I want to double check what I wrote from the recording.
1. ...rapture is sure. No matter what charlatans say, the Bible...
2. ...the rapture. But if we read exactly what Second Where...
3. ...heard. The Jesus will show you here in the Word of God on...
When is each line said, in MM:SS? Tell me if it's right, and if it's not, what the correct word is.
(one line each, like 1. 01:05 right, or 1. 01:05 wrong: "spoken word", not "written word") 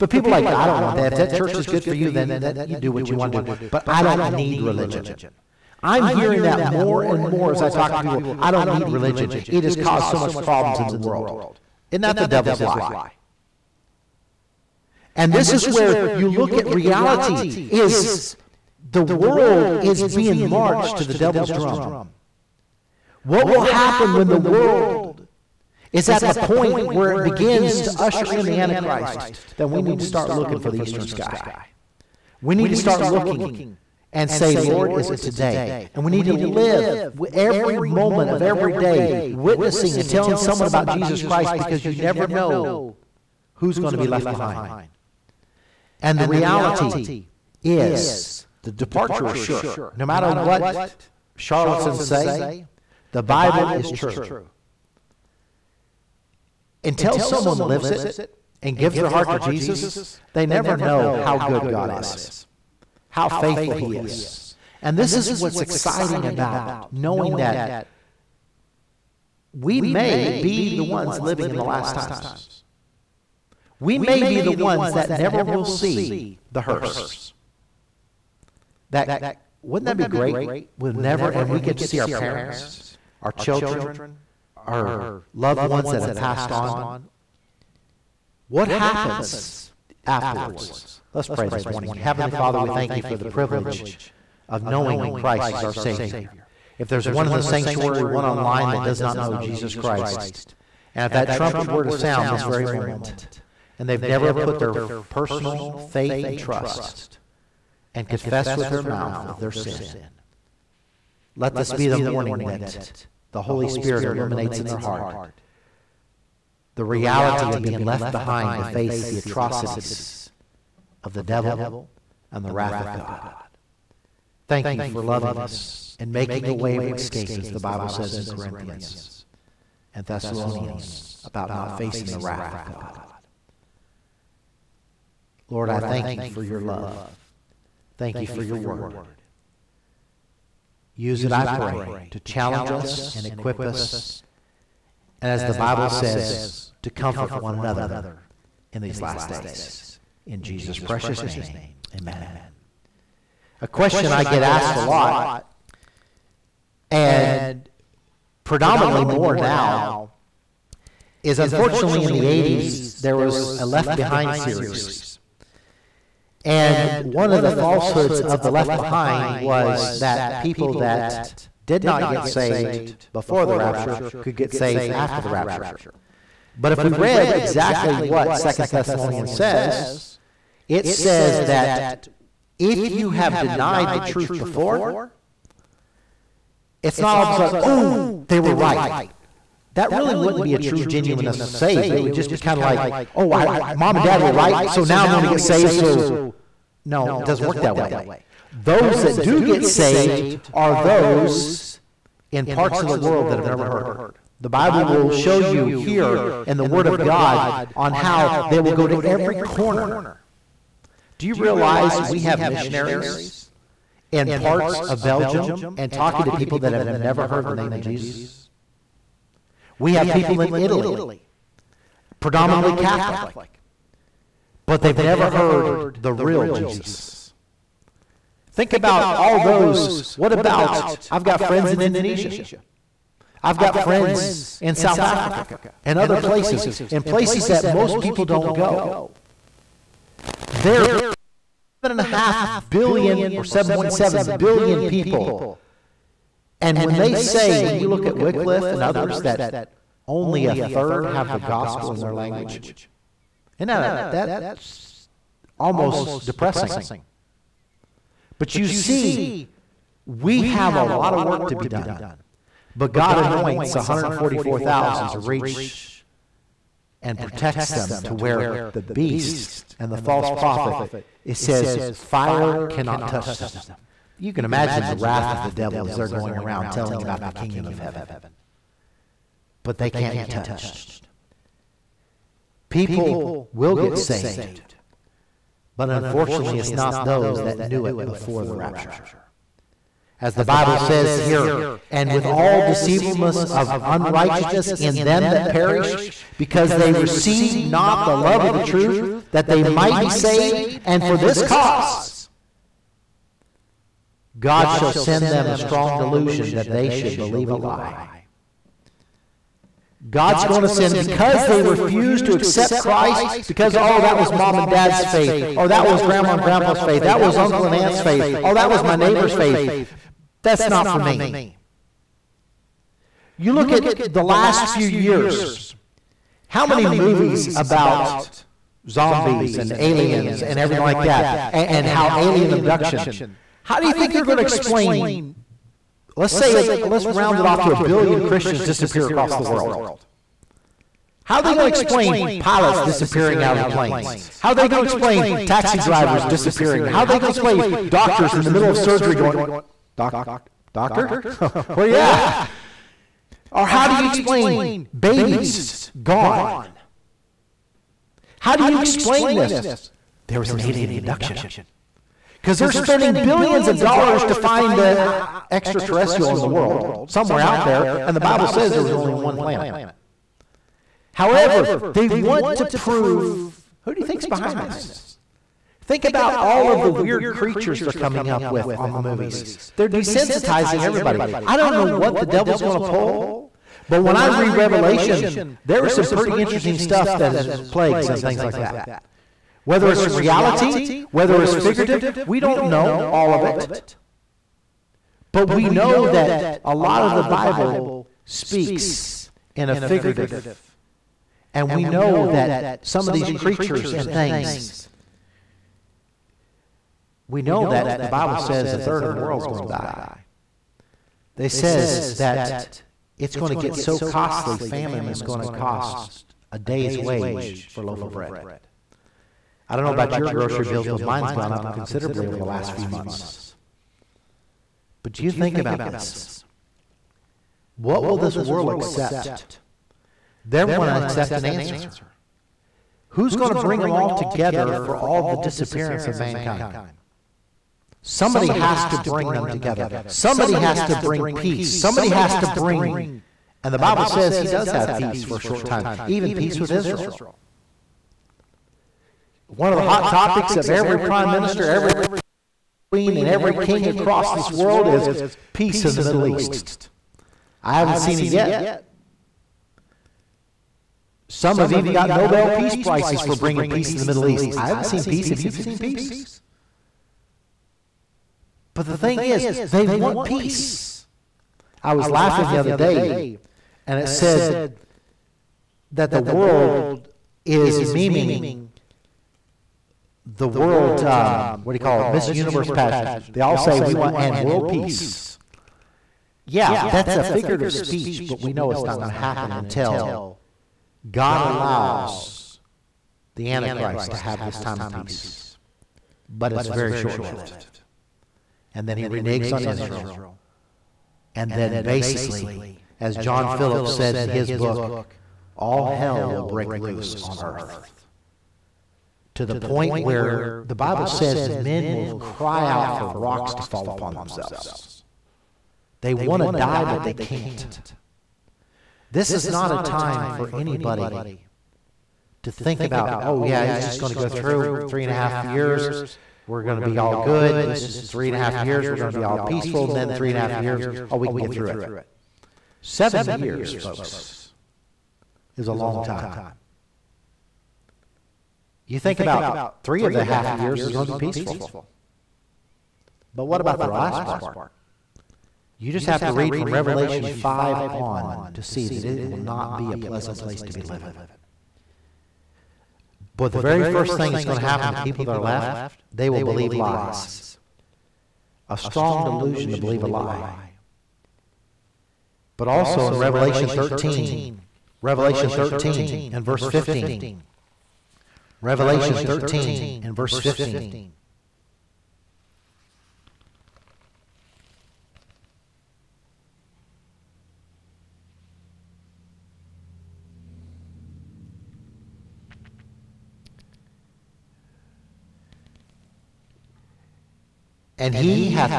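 1. 00:48 wrong: "departure", not "rapture"
2. 02:55 wrong: "Thessalonians", not "Where"
3. 03:23 wrong: "Bible", not "Jesus".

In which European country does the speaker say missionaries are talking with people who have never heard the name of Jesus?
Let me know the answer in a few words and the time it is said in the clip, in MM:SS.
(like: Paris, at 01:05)
Belgium, at 03:35.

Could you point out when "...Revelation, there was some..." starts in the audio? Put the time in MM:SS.
06:24.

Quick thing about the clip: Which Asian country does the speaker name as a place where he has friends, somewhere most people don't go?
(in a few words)
Indonesia.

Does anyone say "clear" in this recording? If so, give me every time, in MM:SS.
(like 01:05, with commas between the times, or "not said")
not said.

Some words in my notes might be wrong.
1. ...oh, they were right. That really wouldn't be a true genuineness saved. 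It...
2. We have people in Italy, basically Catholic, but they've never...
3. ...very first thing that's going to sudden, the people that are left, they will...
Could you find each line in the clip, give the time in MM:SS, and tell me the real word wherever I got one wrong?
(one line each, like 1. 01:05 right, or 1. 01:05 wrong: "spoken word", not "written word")
1. 03:07 right
2. 03:39 wrong: "predominantly", not "basically"
3. 09:13 wrong: "happen", not "sudden".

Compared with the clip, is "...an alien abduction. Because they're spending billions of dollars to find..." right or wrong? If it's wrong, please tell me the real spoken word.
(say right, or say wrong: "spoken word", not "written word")
right.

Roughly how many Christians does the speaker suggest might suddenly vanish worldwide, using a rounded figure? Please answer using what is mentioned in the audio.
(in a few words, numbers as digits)
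1 billion.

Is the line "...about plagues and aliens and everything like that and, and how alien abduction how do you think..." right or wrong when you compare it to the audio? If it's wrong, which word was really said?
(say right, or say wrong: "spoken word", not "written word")
wrong: "zombies", not "plagues".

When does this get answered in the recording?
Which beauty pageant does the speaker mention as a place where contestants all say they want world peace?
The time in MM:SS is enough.
08:02.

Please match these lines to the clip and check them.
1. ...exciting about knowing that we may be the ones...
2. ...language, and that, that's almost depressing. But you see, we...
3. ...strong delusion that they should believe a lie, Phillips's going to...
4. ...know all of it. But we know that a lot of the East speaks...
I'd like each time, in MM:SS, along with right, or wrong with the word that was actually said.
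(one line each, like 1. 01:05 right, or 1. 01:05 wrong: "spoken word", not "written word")
1. 01:05 right
2. 04:12 right
3. 05:05 wrong: "God", not "Phillips"
4. 06:32 wrong: "Bible", not "East".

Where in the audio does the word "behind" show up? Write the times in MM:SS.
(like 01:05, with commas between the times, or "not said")
00:44, 01:58, 02:43, 02:48, 06:14.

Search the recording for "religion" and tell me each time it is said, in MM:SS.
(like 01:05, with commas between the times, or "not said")
00:04, 00:08.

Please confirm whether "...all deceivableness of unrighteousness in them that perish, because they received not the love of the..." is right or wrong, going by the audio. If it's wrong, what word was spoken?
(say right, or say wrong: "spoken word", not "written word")
right.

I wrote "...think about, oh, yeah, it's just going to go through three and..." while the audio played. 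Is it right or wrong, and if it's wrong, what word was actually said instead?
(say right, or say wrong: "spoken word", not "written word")
right.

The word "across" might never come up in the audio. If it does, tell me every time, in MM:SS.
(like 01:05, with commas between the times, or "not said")
05:39, 07:33.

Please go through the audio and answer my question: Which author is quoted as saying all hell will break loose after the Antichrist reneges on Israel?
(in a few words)
John Phillips.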